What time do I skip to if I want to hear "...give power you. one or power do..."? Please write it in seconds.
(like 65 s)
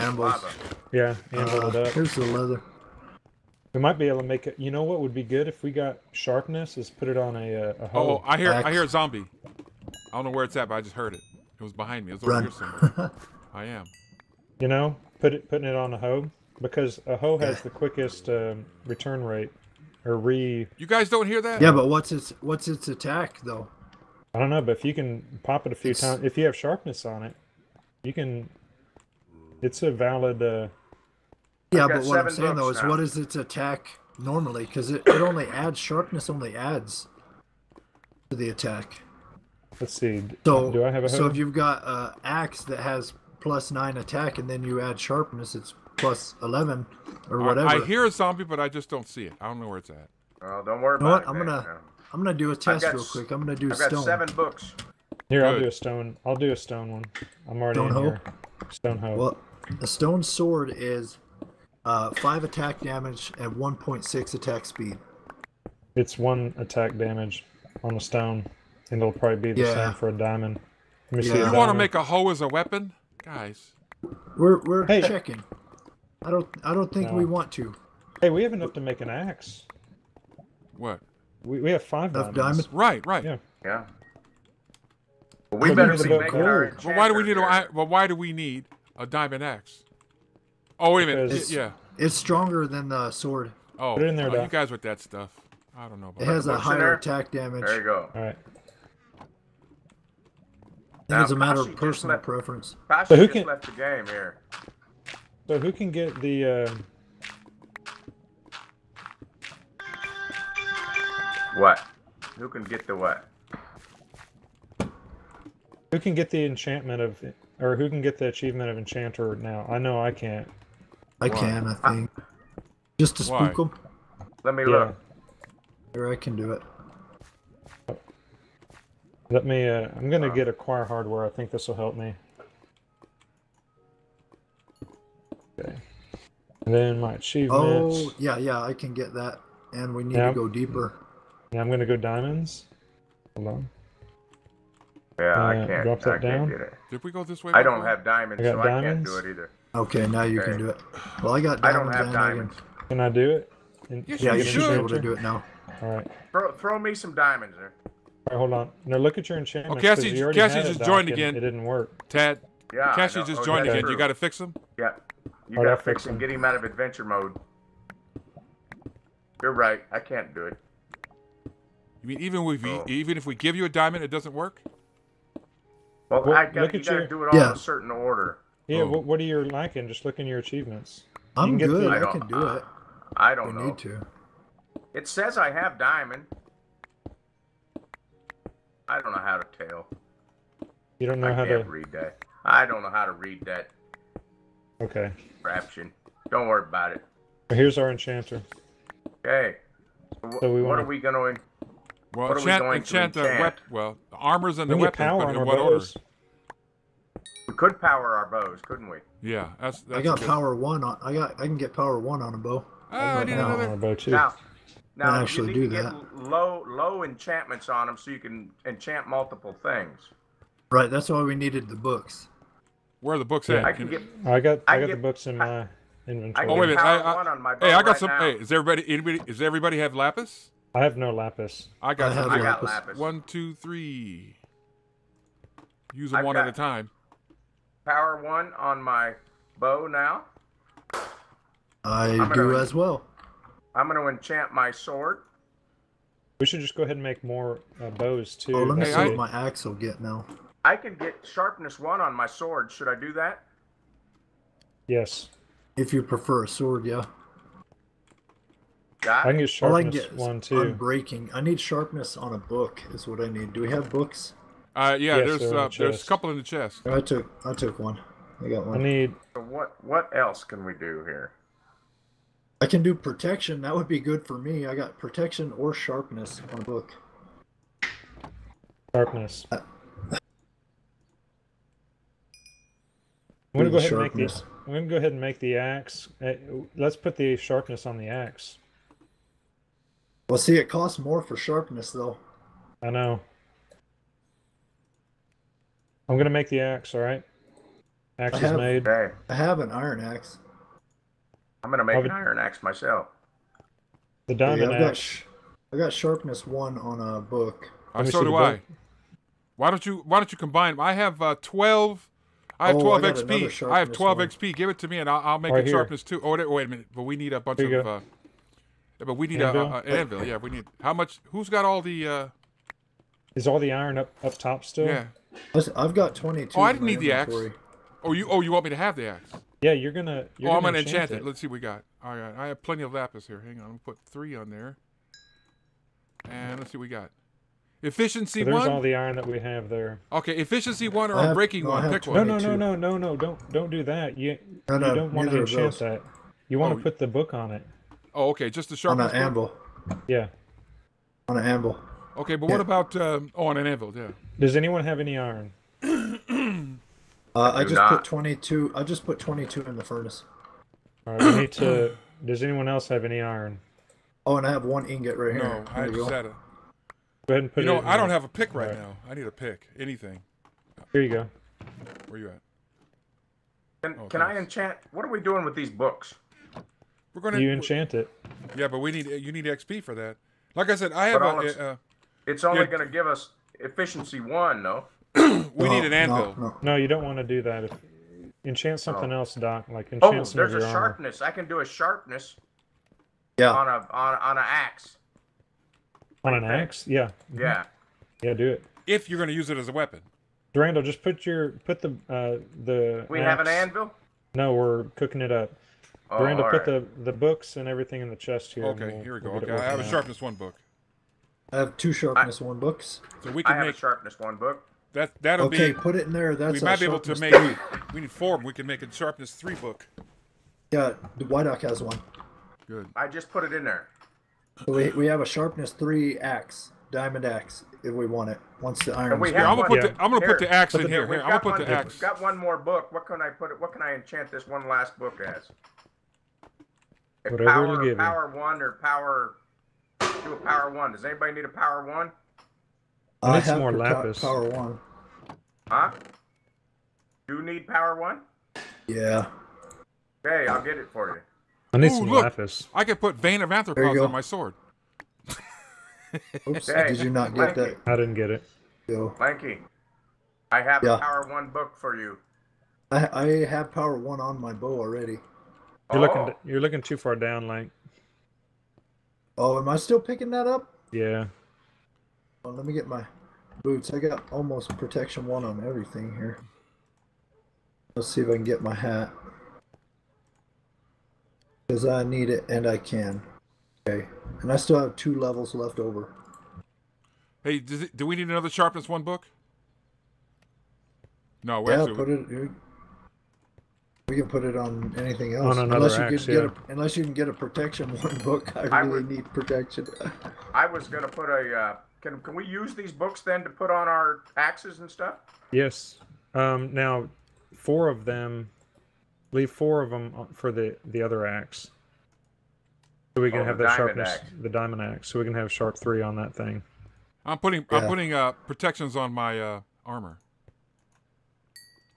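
437 s.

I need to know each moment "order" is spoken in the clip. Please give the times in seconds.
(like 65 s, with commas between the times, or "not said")
177 s, 205 s.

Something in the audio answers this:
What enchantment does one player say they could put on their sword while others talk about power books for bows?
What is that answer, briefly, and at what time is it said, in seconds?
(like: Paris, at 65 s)
Bane of Arthropods, at 453 s.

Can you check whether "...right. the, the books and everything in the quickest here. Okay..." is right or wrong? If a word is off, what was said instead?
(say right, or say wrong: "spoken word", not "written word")
wrong: "chest", not "quickest".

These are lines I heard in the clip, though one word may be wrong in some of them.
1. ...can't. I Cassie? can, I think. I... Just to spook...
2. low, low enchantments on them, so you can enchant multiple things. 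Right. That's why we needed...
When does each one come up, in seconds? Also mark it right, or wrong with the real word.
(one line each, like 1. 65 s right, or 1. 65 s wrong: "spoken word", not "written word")
1. 120 s wrong: "Why", not "Cassie"
2. 216 s right.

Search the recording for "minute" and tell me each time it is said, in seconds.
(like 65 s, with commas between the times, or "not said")
91 s, 226 s, 316 s.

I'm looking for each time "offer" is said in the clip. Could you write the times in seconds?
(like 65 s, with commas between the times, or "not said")
not said.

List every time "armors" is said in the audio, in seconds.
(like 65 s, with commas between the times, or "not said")
204 s, 391 s, 519 s.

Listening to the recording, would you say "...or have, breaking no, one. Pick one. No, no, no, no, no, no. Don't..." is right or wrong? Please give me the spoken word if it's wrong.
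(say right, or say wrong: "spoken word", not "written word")
right.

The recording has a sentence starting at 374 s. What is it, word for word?
What are we doing with these books?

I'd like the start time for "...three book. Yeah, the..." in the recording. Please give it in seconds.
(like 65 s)
419 s.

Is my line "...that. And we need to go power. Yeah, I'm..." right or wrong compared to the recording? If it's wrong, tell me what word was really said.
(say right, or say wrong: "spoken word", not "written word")
wrong: "deeper", not "power".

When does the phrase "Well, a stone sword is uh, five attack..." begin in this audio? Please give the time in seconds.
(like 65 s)
59 s.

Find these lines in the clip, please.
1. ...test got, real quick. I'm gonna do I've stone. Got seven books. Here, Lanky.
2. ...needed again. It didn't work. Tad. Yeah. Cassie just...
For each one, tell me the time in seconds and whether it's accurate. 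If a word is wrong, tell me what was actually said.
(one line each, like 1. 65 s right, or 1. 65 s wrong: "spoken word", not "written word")
1. 52 s wrong: "Good", not "Lanky"
2. 160 s wrong: "joined", not "needed".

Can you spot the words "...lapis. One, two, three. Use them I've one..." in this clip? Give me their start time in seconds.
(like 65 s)
232 s.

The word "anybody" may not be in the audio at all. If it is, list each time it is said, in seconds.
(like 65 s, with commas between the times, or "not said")
228 s, 441 s.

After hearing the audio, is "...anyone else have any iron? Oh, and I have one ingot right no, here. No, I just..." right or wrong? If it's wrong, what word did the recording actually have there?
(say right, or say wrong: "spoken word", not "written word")
right.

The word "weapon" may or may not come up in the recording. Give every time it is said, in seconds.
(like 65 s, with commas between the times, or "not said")
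72 s, 204 s, 399 s.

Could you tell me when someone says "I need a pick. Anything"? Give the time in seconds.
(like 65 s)
369 s.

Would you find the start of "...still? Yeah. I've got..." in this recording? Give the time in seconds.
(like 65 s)
324 s.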